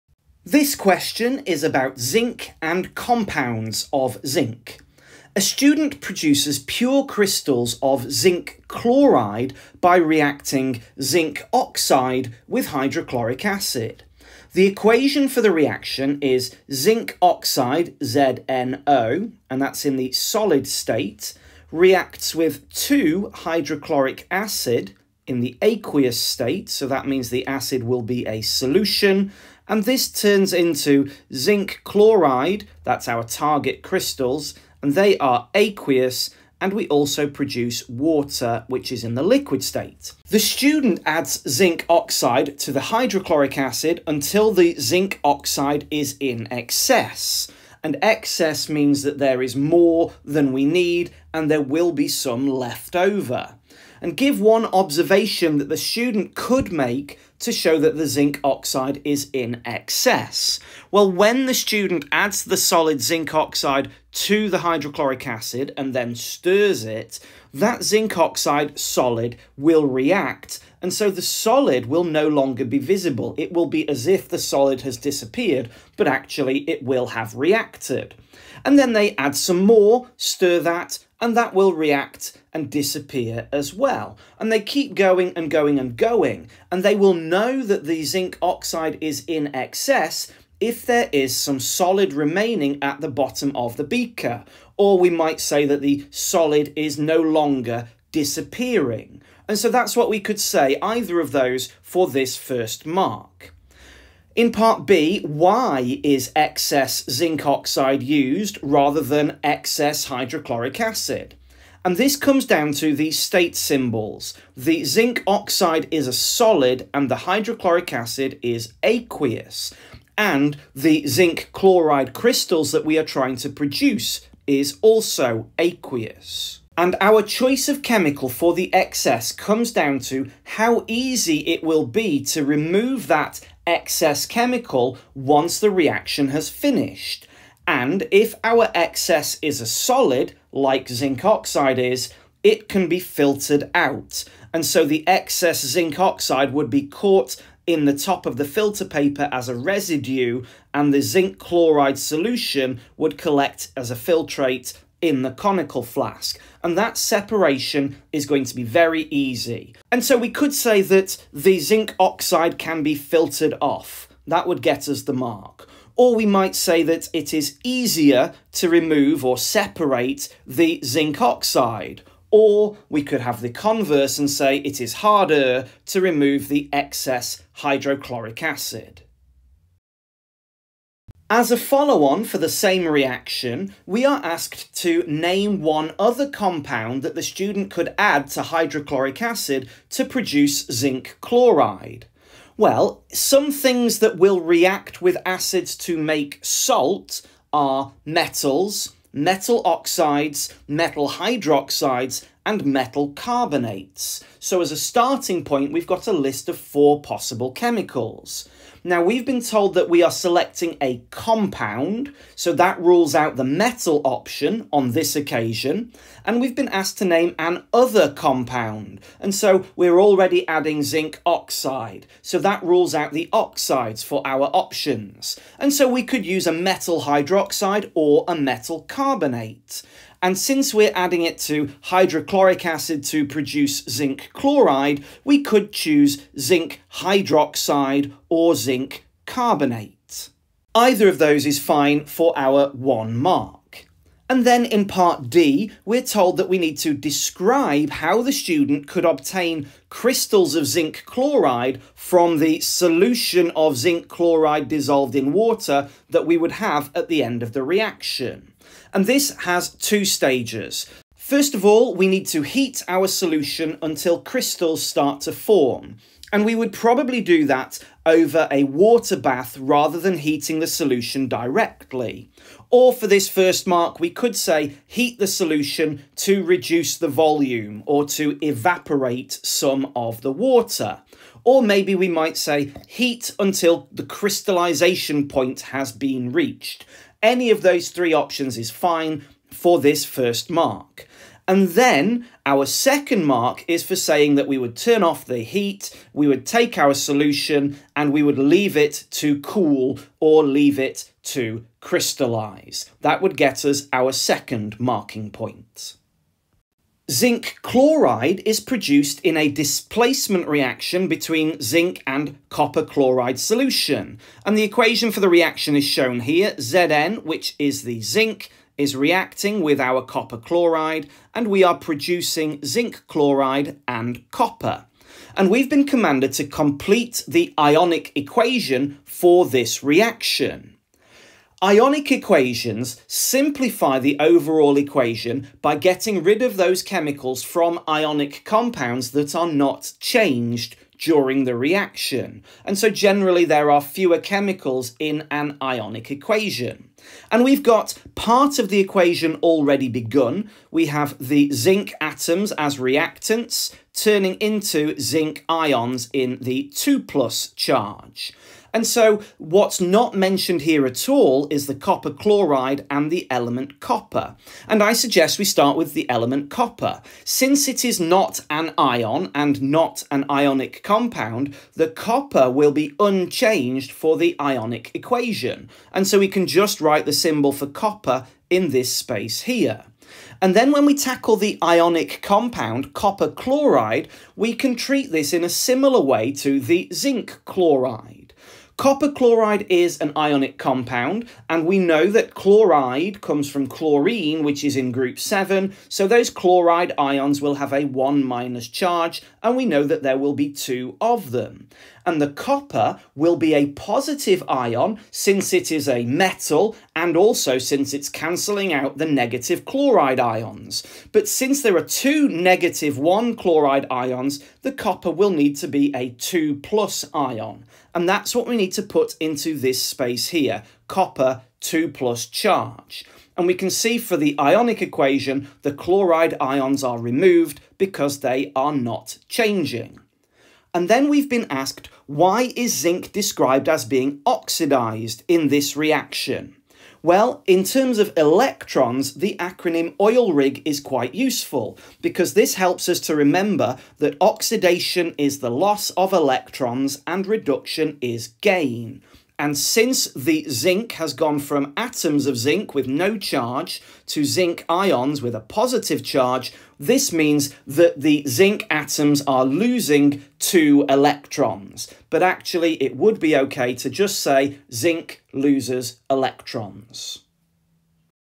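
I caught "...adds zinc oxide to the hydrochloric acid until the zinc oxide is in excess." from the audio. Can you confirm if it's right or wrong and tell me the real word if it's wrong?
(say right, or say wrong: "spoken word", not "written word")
right.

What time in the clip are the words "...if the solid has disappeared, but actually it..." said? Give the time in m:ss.
1:14.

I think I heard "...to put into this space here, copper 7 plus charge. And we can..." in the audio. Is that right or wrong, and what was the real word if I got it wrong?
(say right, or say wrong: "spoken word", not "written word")
wrong: "2", not "7".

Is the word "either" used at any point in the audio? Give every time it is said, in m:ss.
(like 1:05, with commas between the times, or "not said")
1:40, 4:00.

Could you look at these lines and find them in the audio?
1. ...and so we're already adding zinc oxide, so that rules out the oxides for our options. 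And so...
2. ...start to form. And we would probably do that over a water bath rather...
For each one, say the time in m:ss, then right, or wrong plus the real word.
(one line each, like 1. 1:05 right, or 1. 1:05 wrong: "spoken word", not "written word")
1. 3:39 right
2. 4:24 right.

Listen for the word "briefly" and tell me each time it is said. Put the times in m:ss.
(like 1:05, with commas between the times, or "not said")
not said.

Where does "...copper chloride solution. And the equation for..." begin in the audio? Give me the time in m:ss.
5:12.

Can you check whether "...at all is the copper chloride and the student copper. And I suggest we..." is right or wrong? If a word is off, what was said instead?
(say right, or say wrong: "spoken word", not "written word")
wrong: "element", not "student".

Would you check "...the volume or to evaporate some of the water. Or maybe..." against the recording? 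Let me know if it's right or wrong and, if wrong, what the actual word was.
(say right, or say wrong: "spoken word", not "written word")
right.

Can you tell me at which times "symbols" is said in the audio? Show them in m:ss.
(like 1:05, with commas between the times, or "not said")
1:53, 6:17.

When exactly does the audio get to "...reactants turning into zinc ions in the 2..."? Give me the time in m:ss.
5:52.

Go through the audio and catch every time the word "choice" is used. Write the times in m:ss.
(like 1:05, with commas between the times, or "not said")
2:07.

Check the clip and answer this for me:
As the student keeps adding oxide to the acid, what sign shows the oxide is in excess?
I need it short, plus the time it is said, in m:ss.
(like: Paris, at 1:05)
solid remaining at the bottom, at 1:31.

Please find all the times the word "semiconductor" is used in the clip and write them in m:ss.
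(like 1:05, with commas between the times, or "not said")
not said.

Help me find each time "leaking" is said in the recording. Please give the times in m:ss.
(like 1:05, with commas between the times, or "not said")
not said.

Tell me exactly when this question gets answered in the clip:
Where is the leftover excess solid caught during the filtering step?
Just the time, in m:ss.
2:27.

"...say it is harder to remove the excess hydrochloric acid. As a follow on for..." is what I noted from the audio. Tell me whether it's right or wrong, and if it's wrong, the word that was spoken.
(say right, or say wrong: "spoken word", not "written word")
right.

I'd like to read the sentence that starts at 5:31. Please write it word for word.
Ionic equations simplify the overall equation by getting rid of those chemicals from ionic compounds that are not changed during the reaction.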